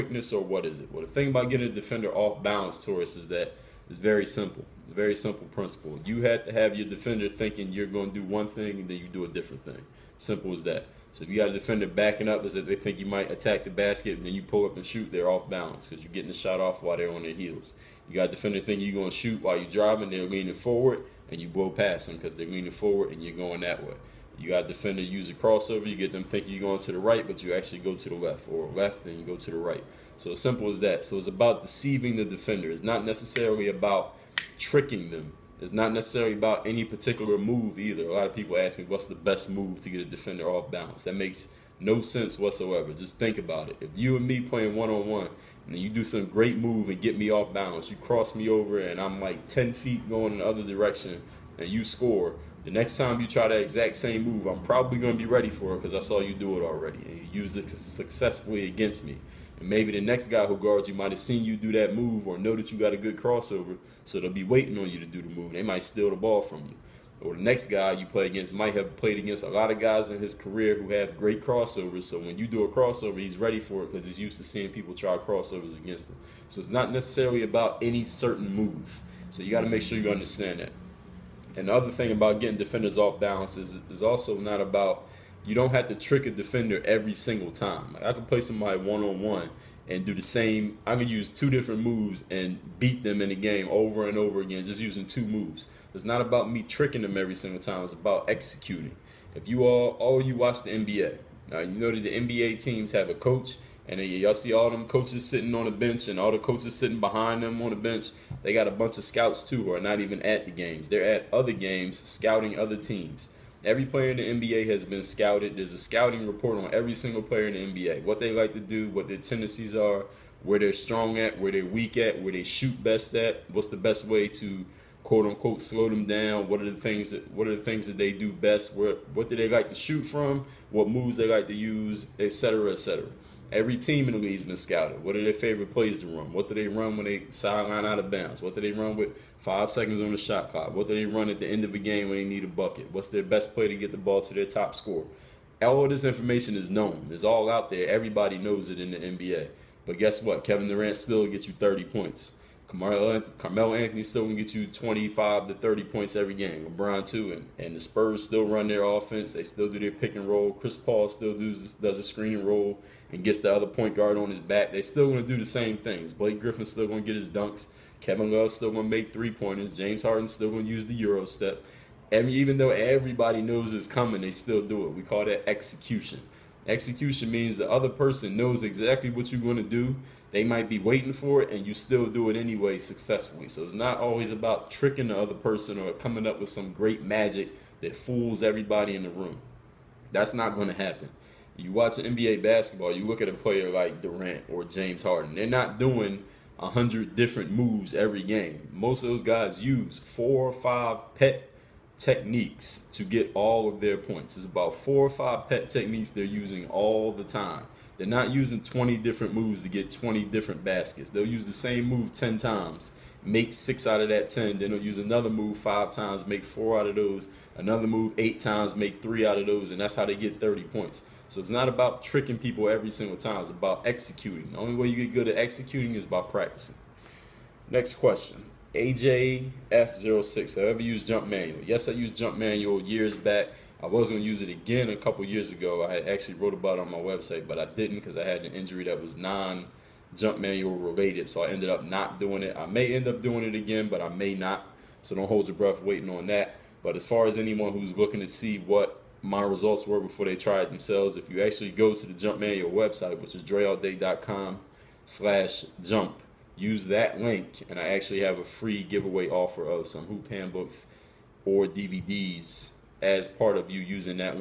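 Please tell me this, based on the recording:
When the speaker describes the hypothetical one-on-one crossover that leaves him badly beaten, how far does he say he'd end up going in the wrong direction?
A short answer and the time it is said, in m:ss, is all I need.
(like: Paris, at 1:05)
10 feet, at 0:49.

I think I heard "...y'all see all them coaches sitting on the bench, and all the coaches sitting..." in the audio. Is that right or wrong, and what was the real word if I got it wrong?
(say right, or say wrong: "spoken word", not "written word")
right.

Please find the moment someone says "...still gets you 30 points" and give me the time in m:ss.
2:30.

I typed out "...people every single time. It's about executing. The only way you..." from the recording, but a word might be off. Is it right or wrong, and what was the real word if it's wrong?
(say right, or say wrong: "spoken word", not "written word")
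right.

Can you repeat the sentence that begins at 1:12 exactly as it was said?
So when you do a crossover, he's ready for it because he's used to seeing people try crossovers against him.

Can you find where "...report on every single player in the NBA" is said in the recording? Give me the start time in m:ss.
1:56.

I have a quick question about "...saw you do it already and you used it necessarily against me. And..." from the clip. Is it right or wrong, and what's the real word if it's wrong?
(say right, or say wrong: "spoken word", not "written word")
wrong: "successfully", not "necessarily".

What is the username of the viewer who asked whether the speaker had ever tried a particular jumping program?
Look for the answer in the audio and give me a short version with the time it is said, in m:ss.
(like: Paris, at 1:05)
AJF06, at 3:48.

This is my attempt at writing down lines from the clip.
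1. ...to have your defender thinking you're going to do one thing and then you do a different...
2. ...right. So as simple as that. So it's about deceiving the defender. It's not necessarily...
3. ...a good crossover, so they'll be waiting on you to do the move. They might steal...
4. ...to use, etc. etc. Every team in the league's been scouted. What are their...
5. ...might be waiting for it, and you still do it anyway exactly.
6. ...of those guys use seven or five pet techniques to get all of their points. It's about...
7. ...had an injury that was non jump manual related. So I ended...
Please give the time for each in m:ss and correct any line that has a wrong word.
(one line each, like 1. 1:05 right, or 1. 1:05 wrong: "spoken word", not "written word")
1. 0:06 right
2. 0:29 right
3. 1:02 right
4. 2:11 right
5. 3:00 wrong: "successfully", not "exactly"
6. 3:19 wrong: "four", not "seven"
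7. 3:58 right.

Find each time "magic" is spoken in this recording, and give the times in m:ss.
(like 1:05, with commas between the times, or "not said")
3:07.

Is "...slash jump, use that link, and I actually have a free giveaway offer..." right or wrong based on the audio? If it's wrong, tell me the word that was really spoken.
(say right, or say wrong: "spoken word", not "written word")
right.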